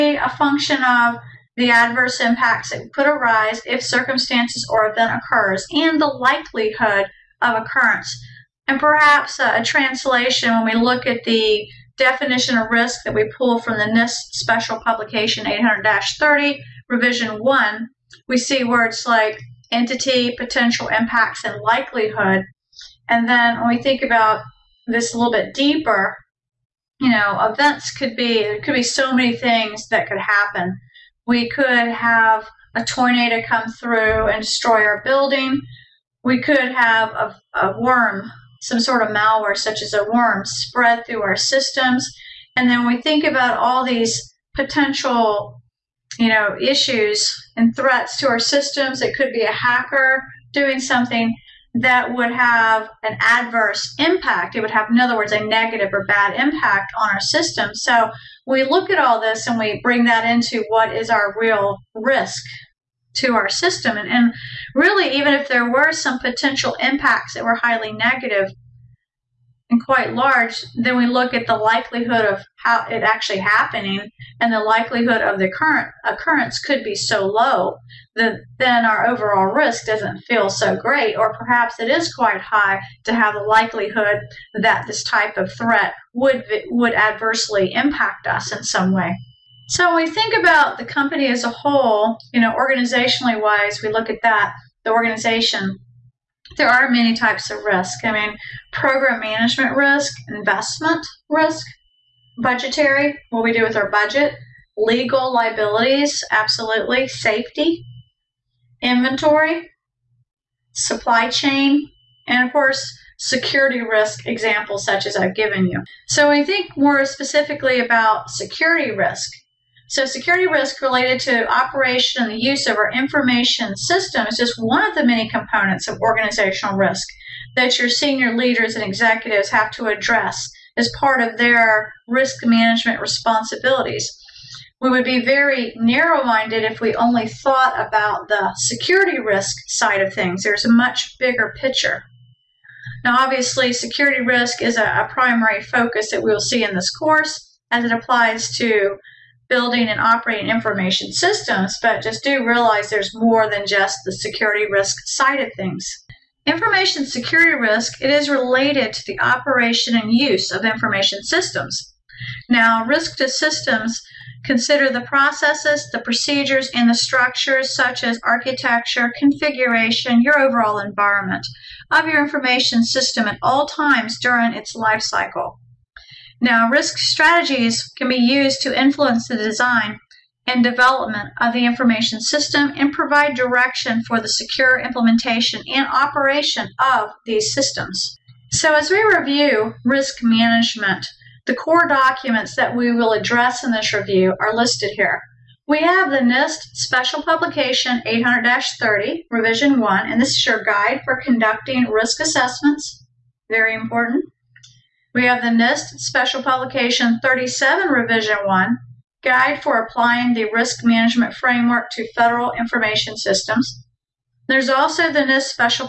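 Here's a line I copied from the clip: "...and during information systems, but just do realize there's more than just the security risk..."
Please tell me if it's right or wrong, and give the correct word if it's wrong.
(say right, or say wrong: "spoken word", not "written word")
wrong: "operating", not "during".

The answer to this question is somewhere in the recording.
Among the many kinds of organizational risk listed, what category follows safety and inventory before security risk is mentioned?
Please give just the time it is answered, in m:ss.
1:50.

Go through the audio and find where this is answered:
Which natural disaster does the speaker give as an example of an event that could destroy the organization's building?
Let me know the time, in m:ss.
0:32.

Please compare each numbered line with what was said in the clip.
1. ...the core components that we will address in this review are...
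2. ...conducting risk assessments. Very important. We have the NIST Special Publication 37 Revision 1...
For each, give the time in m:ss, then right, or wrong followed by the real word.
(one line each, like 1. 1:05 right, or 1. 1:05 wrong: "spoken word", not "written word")
1. 3:11 wrong: "documents", not "components"
2. 3:21 right.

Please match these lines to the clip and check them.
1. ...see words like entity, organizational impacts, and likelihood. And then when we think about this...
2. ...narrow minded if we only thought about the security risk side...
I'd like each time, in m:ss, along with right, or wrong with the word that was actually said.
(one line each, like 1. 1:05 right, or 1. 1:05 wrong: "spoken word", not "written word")
1. 0:18 wrong: "potential", not "organizational"
2. 2:15 right.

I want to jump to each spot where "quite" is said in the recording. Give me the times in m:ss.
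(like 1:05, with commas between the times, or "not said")
1:09, 1:22.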